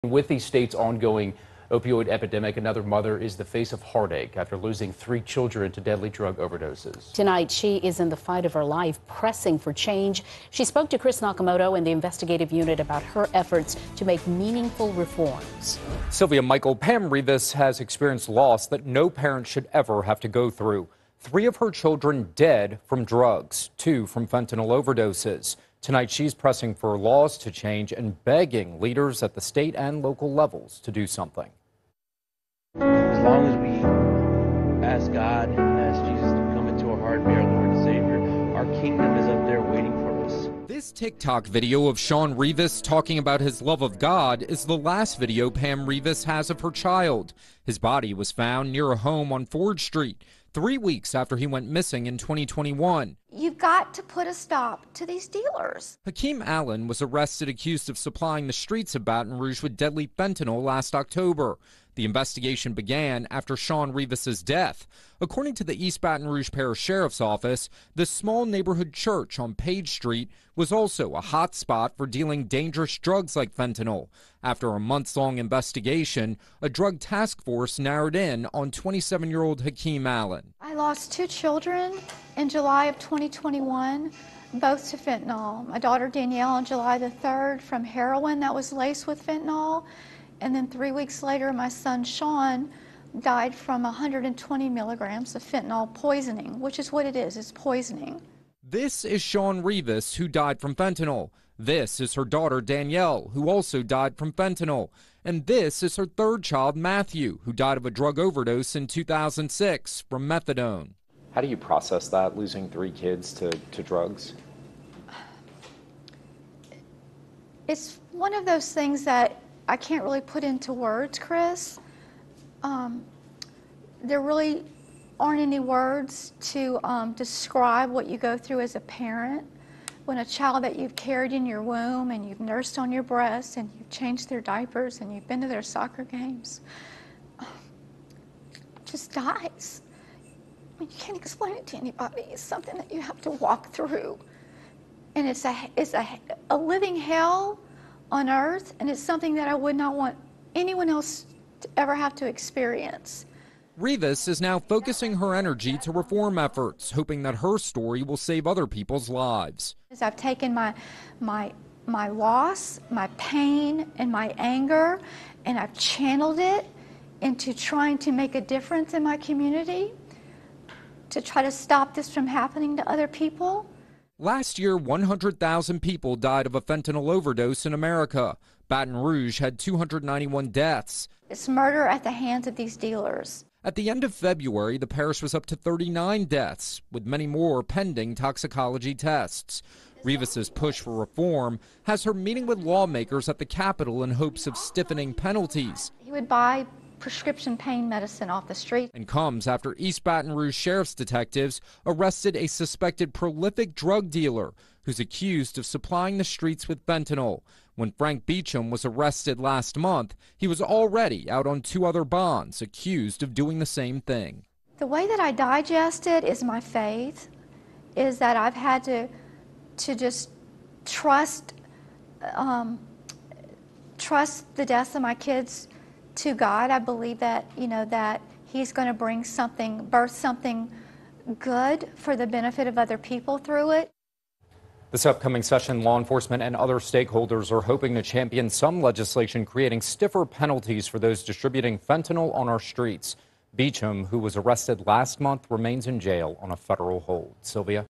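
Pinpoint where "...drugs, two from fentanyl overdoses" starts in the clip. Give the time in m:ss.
0:23.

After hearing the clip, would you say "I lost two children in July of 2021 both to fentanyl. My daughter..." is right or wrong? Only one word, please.
right.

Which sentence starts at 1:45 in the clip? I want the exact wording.
And this is her third child, Matthew, who died of a drug overdose in 2006 from methadone.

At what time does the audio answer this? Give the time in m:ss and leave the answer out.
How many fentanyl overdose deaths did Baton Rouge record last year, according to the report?
2:59.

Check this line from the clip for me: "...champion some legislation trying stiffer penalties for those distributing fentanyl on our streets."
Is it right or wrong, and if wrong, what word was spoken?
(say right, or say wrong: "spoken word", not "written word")
wrong: "creating", not "trying".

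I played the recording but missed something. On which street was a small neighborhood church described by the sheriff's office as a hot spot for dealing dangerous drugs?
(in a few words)
Page Street.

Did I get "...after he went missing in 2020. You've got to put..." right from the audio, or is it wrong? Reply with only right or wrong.
wrong.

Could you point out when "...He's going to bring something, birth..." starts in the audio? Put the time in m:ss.
3:48.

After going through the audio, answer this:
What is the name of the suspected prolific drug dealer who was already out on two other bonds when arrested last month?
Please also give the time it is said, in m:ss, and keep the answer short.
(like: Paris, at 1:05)
Frank Beecham, at 3:27.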